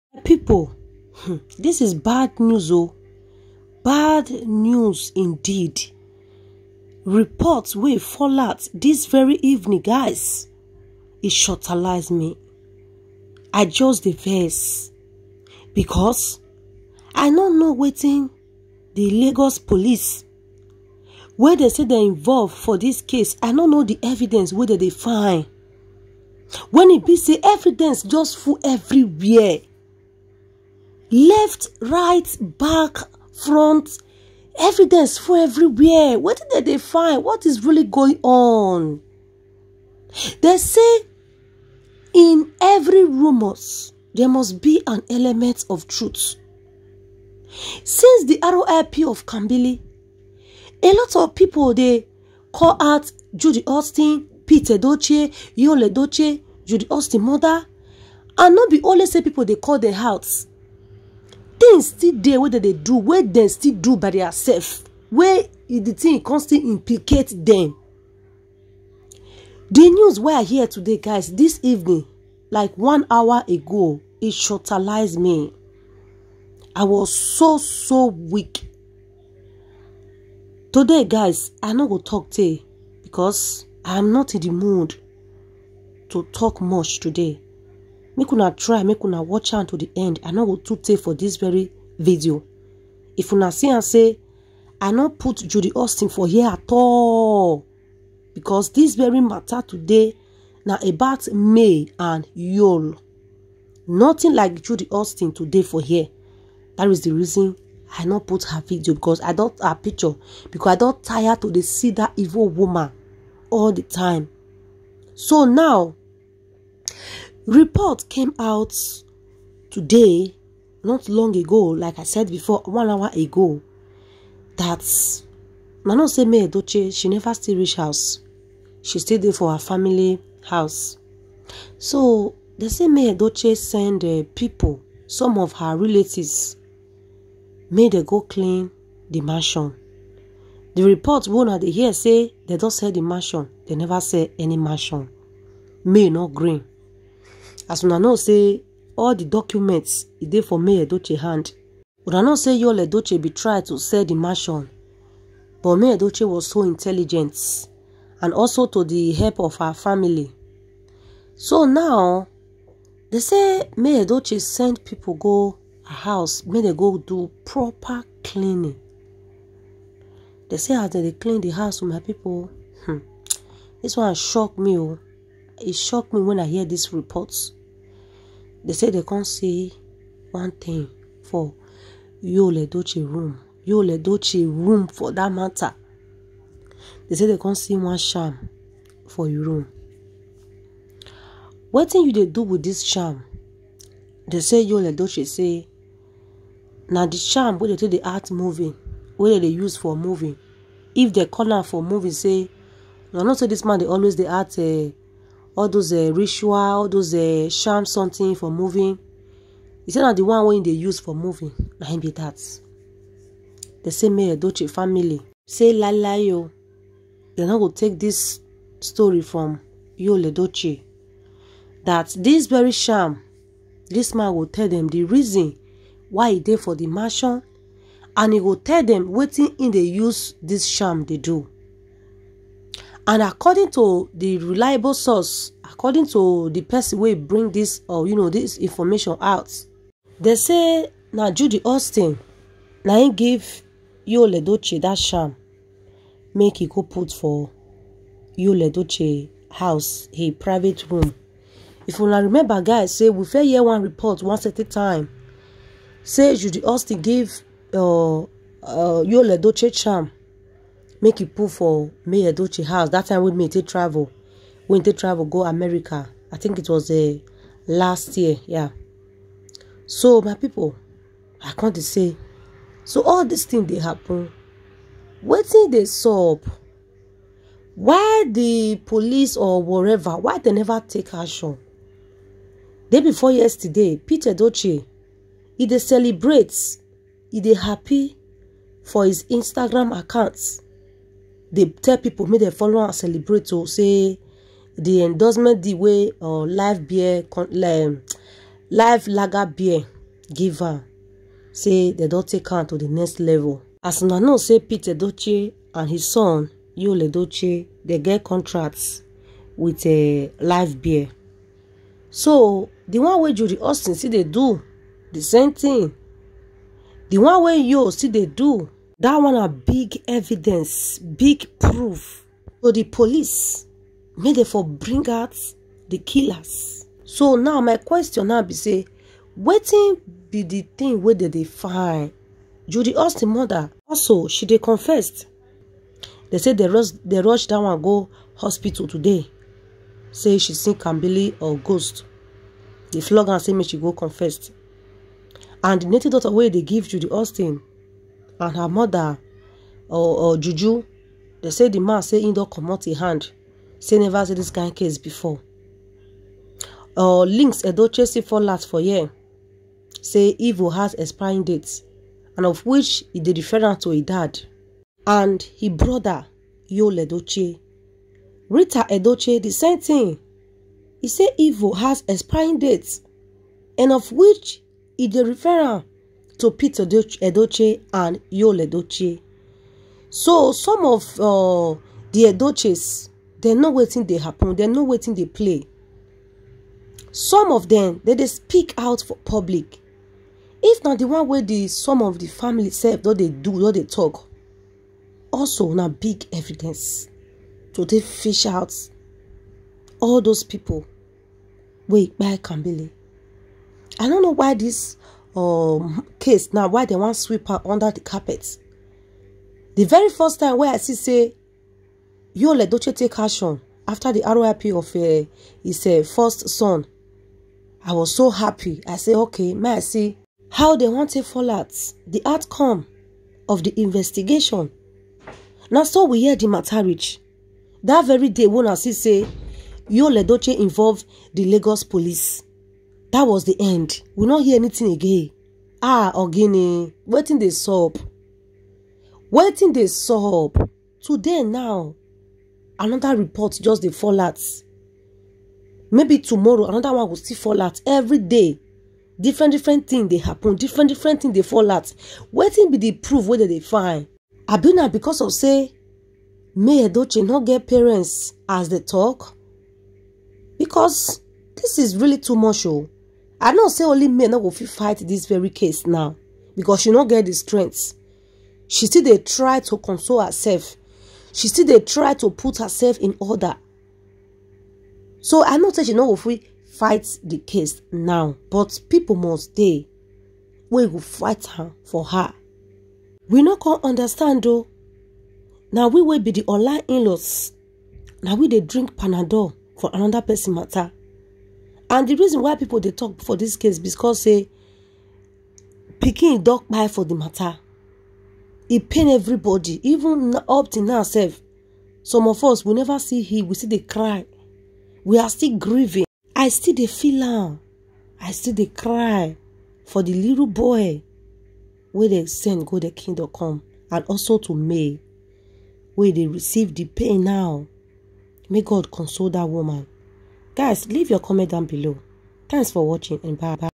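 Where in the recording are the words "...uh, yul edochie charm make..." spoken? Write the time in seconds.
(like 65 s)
258 s.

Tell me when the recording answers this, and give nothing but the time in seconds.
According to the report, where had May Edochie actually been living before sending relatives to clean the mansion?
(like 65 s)
129 s.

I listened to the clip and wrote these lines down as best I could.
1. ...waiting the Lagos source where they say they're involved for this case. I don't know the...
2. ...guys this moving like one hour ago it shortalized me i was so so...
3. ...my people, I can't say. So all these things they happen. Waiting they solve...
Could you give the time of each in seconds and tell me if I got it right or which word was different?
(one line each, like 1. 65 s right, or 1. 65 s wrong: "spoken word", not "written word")
1. 17 s wrong: "police", not "source"
2. 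70 s wrong: "evening", not "moving"
3. 270 s right.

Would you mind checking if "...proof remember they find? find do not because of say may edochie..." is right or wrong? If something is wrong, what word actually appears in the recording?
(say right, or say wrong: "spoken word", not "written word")
wrong: "whether", not "remember".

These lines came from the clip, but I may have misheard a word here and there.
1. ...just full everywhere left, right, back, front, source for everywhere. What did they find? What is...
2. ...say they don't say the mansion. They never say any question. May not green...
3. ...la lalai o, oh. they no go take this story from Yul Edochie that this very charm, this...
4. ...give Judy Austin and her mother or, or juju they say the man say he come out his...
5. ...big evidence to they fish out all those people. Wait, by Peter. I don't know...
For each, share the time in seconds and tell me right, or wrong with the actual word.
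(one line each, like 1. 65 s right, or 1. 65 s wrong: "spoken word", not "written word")
1. 28 s wrong: "evidence", not "source"
2. 141 s wrong: "mansion", not "question"
3. 215 s right
4. 346 s right
5. 395 s wrong: "Kambili", not "Peter".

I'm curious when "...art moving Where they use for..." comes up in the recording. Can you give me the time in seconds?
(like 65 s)
198 s.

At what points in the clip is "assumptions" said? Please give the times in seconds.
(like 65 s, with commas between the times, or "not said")
not said.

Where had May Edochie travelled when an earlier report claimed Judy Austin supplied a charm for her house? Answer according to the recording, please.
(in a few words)
America.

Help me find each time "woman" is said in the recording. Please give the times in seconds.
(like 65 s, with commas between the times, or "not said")
112 s, 519 s.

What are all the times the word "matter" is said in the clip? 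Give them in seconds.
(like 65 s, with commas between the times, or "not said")
99 s, 185 s, 426 s, 490 s, 497 s.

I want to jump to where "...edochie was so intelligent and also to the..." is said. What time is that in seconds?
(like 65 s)
155 s.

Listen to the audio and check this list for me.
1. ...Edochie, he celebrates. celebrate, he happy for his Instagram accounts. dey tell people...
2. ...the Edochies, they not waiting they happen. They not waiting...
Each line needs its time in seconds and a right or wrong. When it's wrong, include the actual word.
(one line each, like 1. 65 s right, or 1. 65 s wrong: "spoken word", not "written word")
1. 284 s right
2. 382 s right.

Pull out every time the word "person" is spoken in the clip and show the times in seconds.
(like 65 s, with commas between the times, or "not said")
236 s, 490 s.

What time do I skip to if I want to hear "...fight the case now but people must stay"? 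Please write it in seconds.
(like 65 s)
476 s.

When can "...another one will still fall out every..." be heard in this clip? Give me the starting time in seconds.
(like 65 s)
446 s.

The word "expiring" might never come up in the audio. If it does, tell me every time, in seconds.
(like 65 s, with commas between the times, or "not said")
360 s, 372 s.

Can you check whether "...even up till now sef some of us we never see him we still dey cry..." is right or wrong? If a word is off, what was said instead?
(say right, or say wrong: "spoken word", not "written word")
right.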